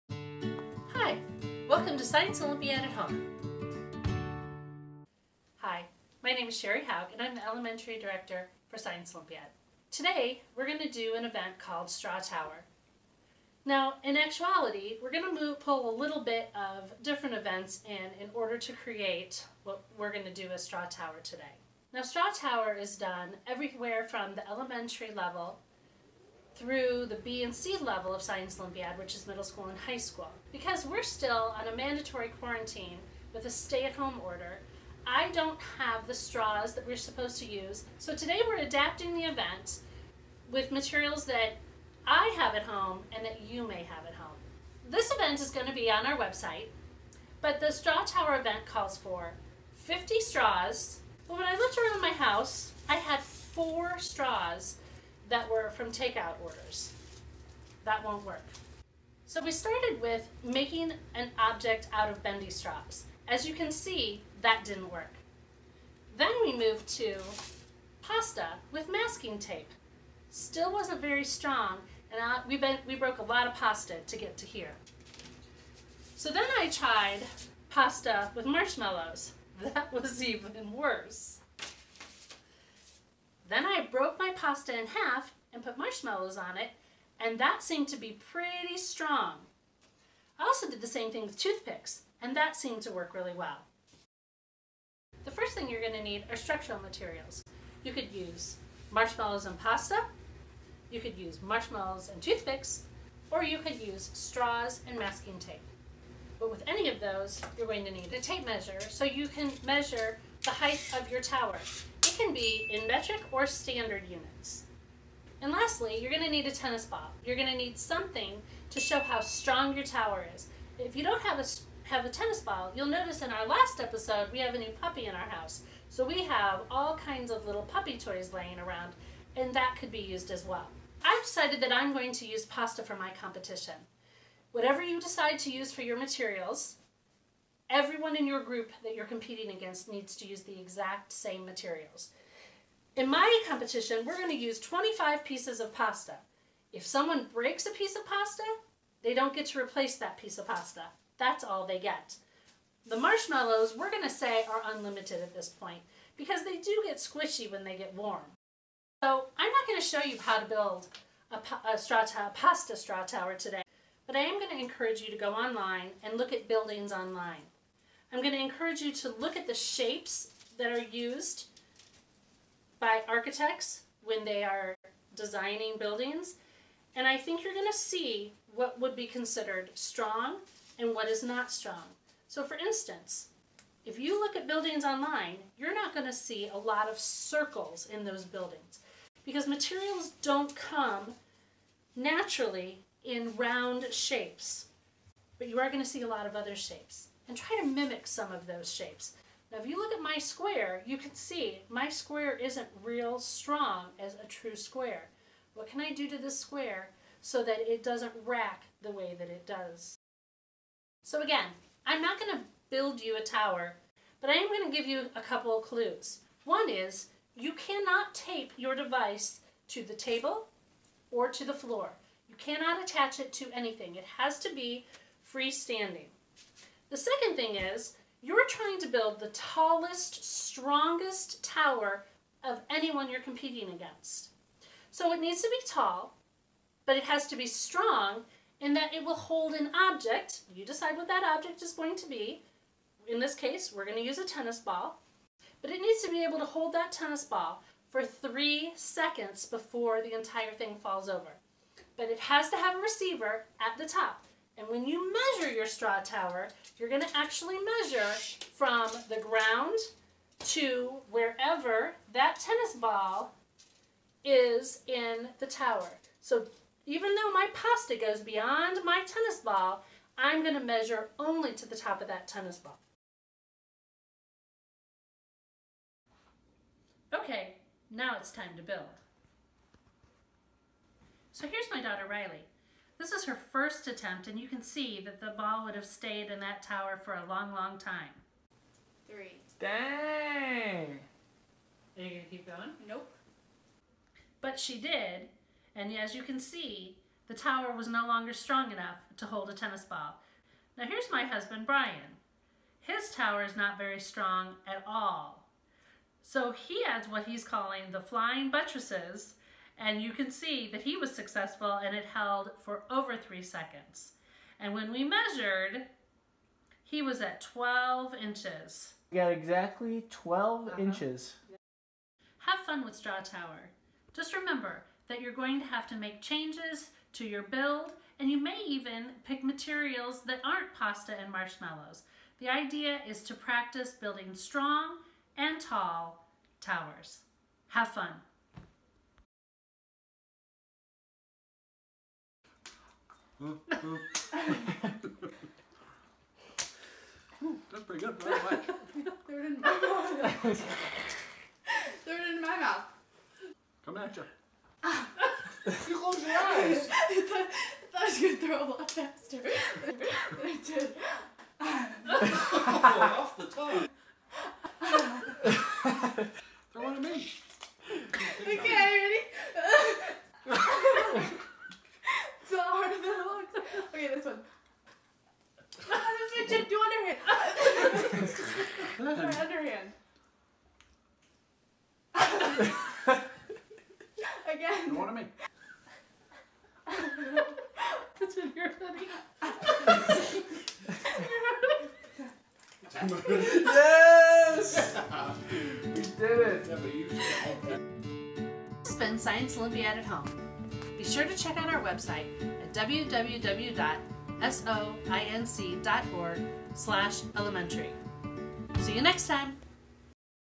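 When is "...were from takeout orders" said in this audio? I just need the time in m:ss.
0:55.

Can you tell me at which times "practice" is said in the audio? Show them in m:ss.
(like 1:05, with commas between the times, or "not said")
5:33.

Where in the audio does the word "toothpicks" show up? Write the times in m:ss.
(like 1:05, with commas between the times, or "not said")
1:31, 1:42.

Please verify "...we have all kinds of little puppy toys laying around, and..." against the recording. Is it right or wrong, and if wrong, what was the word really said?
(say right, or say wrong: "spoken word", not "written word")
right.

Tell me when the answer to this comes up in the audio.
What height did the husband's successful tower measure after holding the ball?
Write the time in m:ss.
5:17.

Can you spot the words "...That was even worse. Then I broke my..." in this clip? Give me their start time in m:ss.
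1:19.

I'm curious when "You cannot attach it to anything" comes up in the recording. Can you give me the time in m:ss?
3:42.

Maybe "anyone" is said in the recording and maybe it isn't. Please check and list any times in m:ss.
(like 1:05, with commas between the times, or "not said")
3:52.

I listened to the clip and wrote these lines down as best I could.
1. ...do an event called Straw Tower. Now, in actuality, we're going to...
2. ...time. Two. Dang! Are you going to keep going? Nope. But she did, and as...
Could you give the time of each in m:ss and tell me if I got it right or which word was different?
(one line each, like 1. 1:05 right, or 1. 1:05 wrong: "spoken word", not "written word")
1. 0:10 right
2. 4:47 wrong: "Three", not "Two".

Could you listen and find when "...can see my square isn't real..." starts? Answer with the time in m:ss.
3:20.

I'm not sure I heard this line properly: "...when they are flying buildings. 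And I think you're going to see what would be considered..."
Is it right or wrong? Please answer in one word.
wrong.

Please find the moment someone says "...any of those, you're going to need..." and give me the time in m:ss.
1:46.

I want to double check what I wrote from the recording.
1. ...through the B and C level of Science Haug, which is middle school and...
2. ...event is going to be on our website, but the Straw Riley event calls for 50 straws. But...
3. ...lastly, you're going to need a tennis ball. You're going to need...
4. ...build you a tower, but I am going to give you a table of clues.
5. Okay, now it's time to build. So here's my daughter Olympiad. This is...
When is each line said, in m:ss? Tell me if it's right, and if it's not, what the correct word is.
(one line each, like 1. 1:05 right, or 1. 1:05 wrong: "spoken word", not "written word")
1. 0:26 wrong: "Olympiad", not "Haug"
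2. 0:45 wrong: "Tower", not "Riley"
3. 1:55 right
4. 3:32 wrong: "couple", not "table"
5. 4:37 wrong: "Riley", not "Olympiad".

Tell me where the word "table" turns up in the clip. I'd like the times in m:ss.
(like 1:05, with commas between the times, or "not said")
3:39.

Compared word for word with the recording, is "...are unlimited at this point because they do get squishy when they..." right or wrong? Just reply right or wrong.
right.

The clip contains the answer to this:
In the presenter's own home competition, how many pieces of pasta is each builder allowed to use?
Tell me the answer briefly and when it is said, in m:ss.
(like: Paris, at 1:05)
25, at 2:24.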